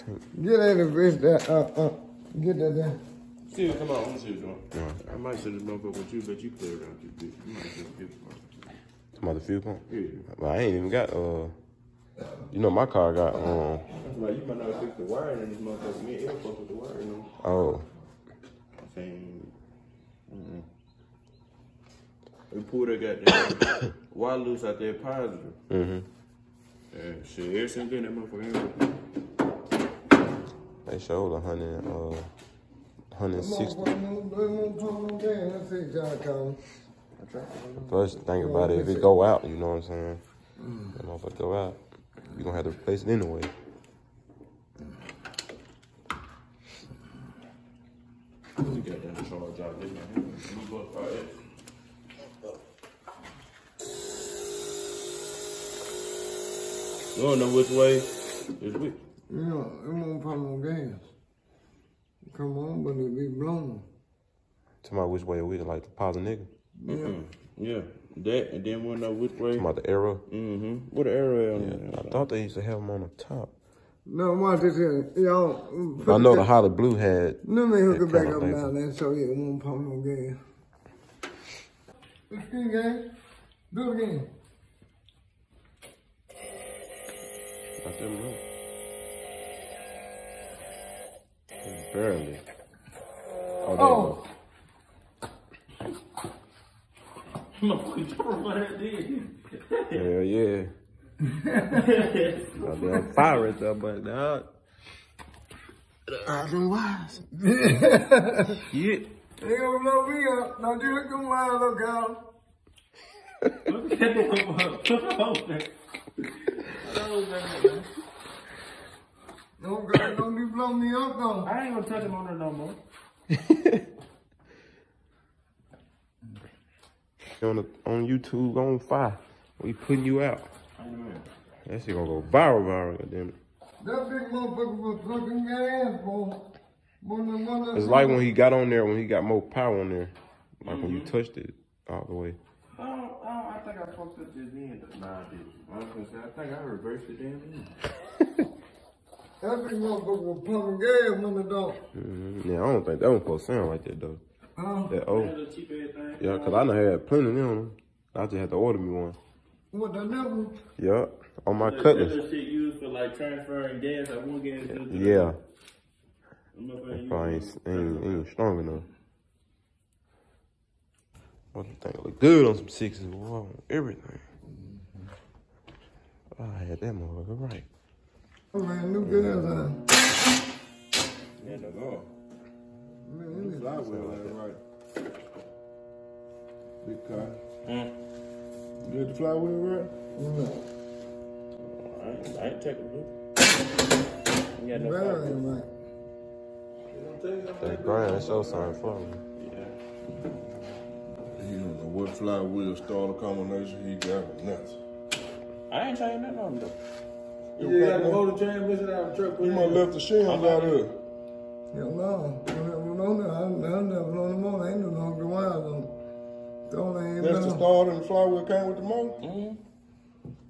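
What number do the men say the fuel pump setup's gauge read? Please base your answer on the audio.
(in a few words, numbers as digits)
160.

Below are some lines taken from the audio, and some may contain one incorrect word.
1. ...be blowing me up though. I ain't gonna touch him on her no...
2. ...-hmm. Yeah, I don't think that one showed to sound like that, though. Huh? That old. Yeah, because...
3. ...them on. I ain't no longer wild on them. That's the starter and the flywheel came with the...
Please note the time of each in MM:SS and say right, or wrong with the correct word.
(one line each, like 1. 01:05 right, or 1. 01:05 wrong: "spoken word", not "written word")
1. 02:00 right
2. 02:32 wrong: "supposed", not "showed"
3. 03:34 right.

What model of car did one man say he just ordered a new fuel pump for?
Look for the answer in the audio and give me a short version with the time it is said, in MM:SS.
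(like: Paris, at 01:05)
Cutlass, at 02:41.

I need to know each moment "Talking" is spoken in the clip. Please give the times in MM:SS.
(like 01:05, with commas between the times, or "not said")
01:04, 01:09.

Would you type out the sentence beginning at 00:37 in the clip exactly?
First thing about it, if it go out, you know what I'm saying?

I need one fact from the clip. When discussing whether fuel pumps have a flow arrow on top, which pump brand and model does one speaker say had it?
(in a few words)
Holley Blue.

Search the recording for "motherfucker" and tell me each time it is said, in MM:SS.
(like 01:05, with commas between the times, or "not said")
00:05, 00:15, 00:28, 00:41, 02:14, 02:29, 02:56.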